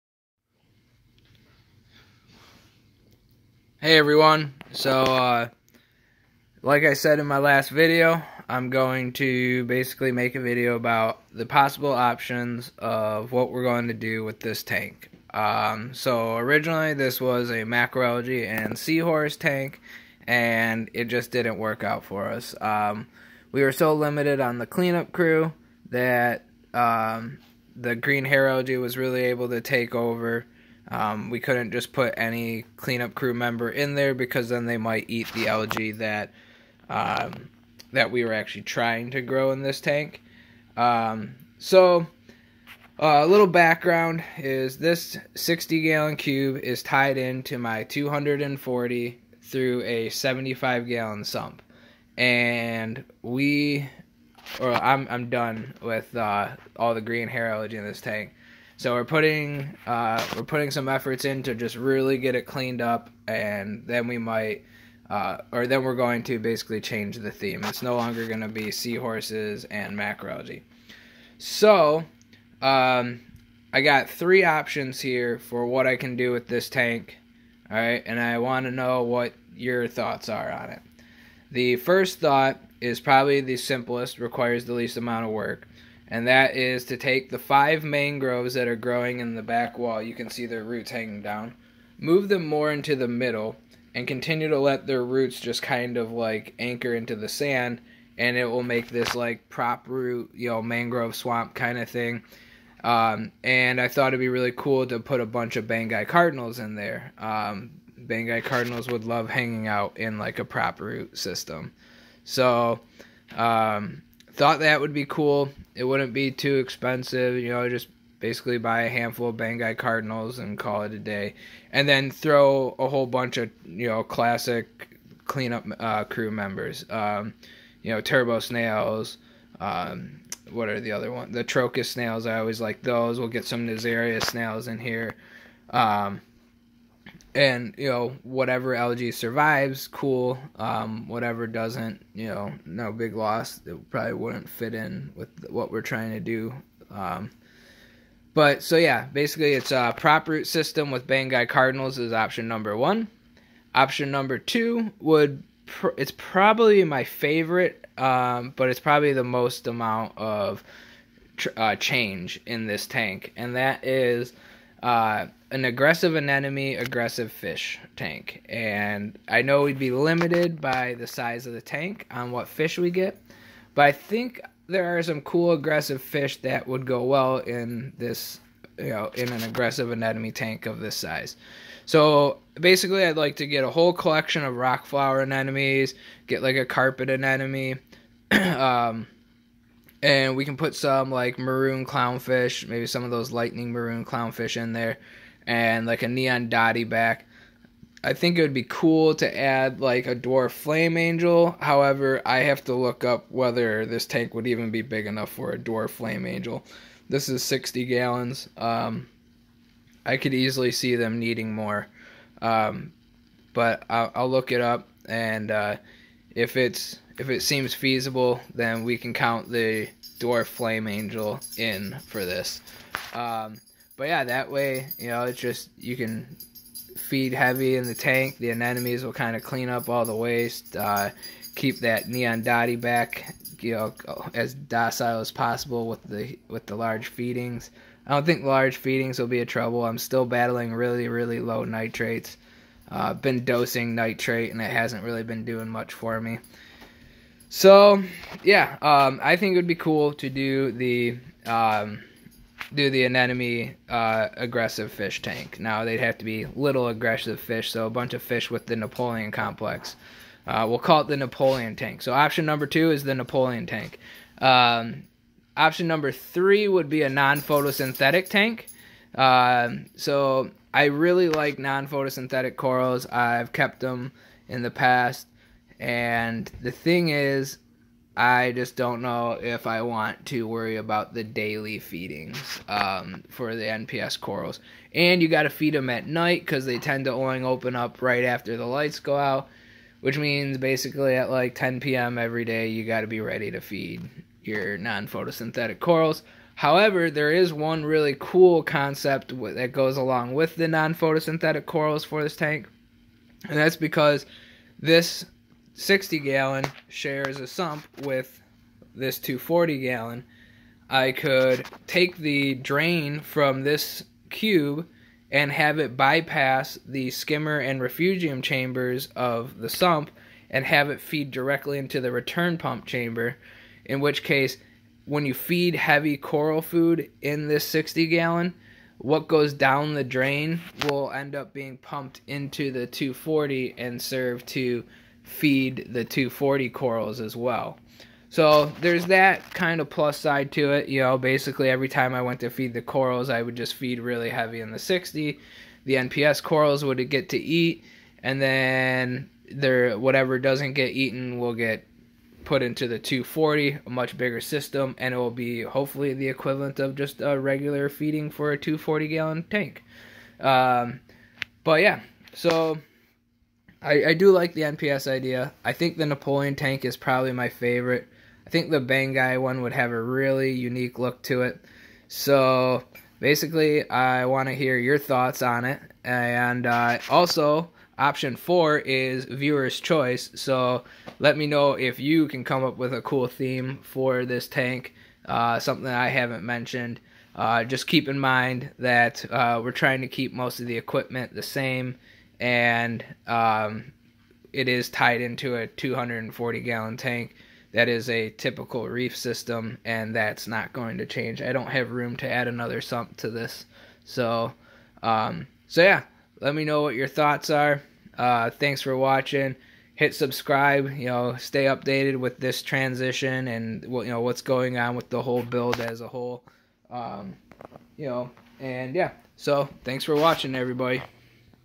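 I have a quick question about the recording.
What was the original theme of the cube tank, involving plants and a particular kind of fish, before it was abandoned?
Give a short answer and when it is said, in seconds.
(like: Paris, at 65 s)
Macroalgae and seahorse, at 17 s.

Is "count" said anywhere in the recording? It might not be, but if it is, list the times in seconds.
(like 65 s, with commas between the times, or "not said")
219 s.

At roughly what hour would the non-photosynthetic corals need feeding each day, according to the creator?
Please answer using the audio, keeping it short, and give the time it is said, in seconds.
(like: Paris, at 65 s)
10 p.m., at 291 s.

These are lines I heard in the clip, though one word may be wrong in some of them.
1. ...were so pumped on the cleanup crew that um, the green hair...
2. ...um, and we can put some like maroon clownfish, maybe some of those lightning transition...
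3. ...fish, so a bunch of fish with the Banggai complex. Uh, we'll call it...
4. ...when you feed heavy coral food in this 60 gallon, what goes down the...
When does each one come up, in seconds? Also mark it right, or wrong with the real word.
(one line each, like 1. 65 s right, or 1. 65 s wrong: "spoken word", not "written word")
1. 23 s wrong: "limited", not "pumped"
2. 188 s wrong: "maroon", not "transition"
3. 257 s wrong: "Napoleon", not "Banggai"
4. 325 s right.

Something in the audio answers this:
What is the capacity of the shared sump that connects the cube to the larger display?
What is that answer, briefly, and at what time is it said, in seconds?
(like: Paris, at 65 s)
75 gallons, at 50 s.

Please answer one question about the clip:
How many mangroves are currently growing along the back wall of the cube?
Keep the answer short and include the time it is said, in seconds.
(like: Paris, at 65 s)
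5, at 87 s.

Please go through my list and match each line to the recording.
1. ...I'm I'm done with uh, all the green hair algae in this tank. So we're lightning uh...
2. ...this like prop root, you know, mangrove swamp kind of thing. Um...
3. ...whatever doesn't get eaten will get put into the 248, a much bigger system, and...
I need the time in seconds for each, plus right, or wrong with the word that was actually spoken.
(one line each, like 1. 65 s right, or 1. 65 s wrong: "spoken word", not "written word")
1. 54 s wrong: "putting", not "lightning"
2. 98 s right
3. 349 s wrong: "240", not "248".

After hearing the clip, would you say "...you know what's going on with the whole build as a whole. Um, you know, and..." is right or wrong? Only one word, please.
right.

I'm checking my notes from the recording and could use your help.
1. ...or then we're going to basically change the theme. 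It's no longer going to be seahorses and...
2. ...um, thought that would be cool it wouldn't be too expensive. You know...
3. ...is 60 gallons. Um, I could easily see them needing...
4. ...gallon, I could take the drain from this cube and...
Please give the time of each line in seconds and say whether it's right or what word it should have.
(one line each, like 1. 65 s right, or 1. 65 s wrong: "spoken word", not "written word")
1. 65 s right
2. 113 s right
3. 207 s right
4. 309 s right.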